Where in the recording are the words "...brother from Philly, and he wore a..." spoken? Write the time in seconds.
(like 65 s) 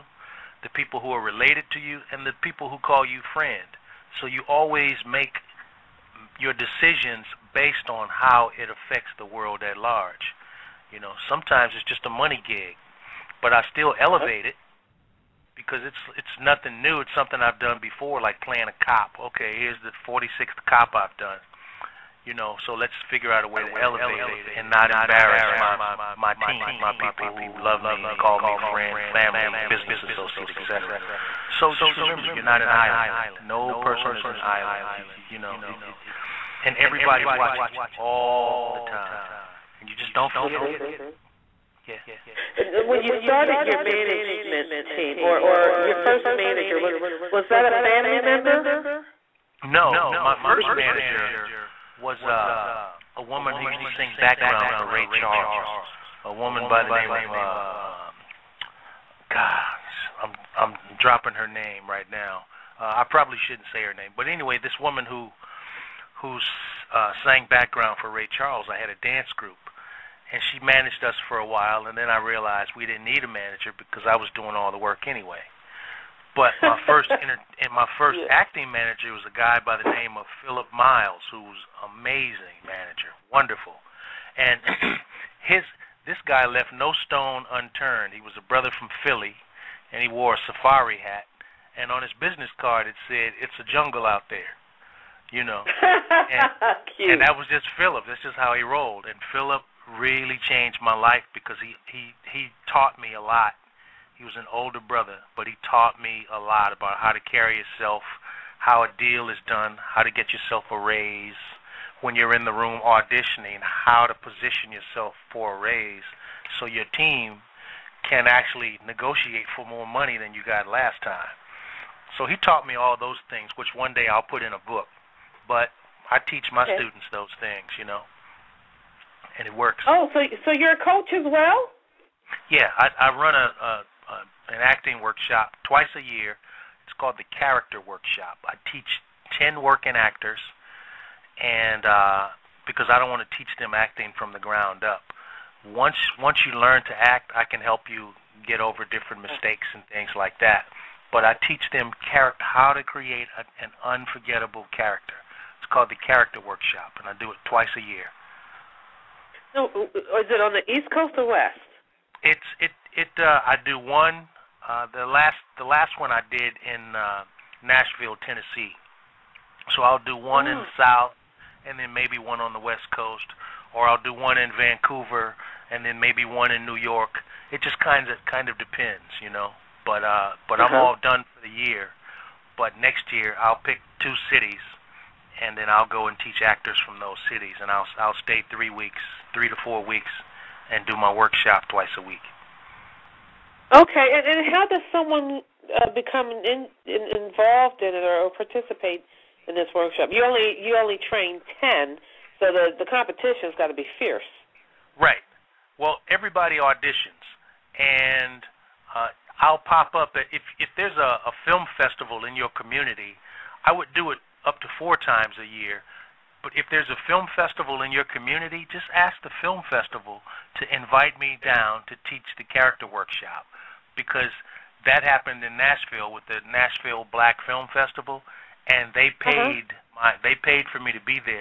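88 s.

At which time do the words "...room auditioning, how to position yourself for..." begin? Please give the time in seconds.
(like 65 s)
112 s.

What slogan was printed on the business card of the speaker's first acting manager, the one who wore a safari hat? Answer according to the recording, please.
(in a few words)
It's a jungle out there.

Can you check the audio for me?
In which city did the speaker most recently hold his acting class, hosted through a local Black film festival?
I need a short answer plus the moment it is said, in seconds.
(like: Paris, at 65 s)
Nashville, Tennessee, at 167 s.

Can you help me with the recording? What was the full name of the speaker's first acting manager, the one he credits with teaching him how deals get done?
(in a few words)
Philip Miles.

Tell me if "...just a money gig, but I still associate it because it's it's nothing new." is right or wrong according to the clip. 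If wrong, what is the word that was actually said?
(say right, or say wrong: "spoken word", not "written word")
wrong: "elevate", not "associate".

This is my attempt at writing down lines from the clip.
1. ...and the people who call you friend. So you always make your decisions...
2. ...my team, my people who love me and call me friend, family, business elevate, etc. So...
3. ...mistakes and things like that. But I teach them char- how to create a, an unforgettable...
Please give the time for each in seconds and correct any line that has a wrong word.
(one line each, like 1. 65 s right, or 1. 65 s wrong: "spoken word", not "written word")
1. 2 s right
2. 26 s wrong: "associate", not "elevate"
3. 149 s right.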